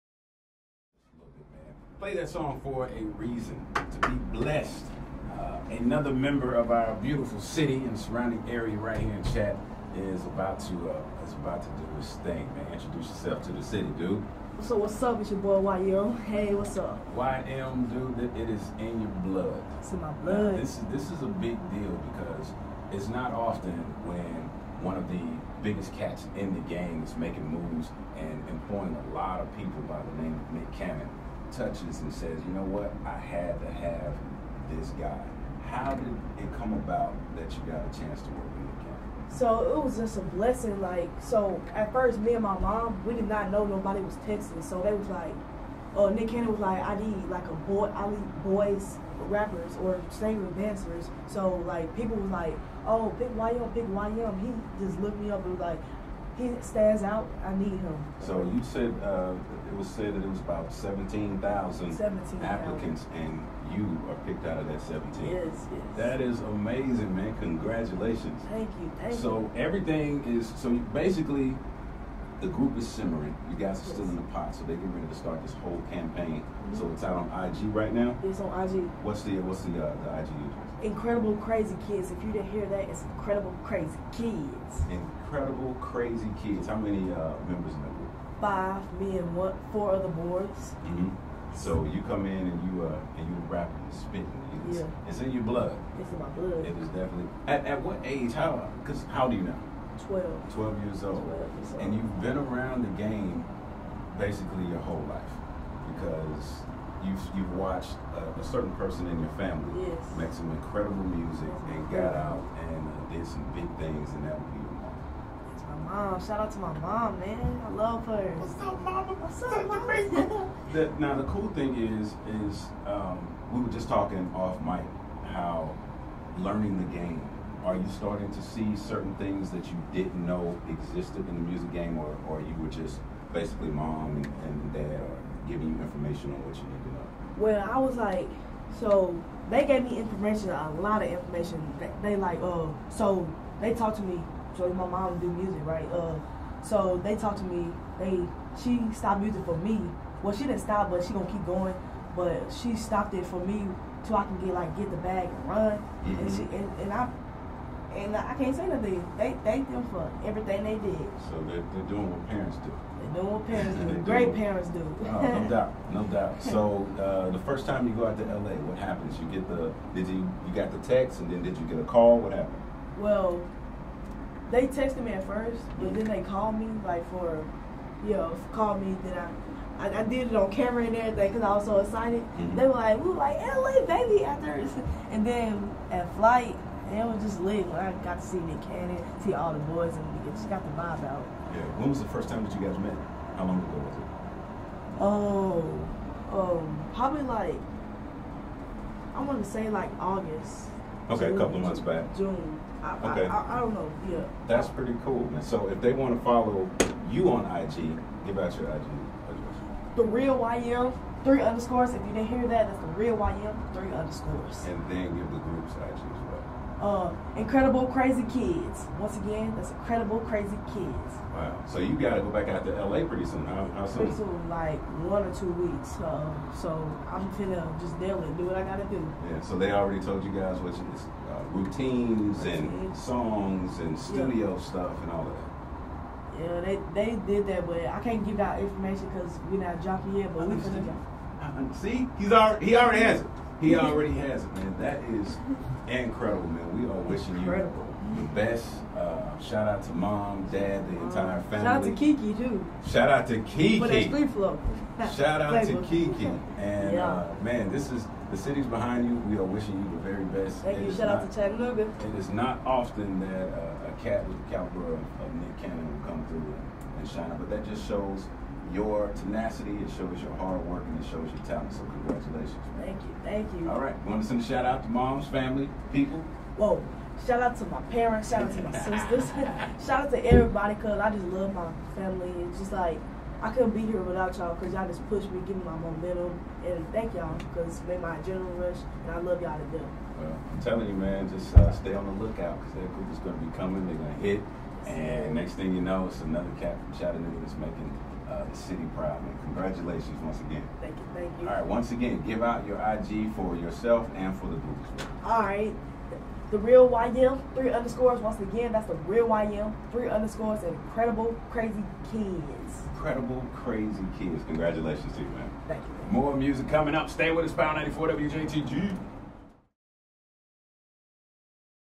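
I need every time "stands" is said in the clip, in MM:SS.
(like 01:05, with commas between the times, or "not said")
00:56.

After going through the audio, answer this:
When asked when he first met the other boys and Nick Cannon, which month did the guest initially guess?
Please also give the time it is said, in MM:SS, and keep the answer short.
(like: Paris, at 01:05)
August, at 03:20.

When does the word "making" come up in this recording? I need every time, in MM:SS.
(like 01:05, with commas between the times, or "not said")
00:27, 04:57.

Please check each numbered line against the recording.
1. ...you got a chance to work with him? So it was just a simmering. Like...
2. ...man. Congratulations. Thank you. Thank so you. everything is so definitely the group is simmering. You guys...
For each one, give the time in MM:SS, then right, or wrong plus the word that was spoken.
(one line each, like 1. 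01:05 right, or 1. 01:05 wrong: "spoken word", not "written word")
1. 00:37 wrong: "blessing", not "simmering"
2. 01:07 wrong: "basically", not "definitely".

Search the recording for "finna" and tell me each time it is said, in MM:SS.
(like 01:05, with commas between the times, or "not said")
03:47, 04:00.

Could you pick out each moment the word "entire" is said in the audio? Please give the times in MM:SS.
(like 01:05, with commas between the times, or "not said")
04:10.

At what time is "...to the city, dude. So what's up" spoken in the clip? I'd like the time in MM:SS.
00:13.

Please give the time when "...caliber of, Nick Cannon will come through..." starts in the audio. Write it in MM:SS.
04:24.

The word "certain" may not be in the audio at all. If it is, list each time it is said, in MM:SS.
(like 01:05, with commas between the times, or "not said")
01:48, 02:08.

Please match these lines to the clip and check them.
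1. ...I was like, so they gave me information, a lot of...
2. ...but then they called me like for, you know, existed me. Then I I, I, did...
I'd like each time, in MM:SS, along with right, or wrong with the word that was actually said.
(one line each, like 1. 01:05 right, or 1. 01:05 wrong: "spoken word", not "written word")
1. 02:17 right
2. 02:55 wrong: "called", not "existed".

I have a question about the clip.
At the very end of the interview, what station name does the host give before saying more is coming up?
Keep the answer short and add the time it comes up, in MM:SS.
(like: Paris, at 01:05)
Power 94, at 05:17.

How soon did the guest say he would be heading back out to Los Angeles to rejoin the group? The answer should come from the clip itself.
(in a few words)
one or two weeks.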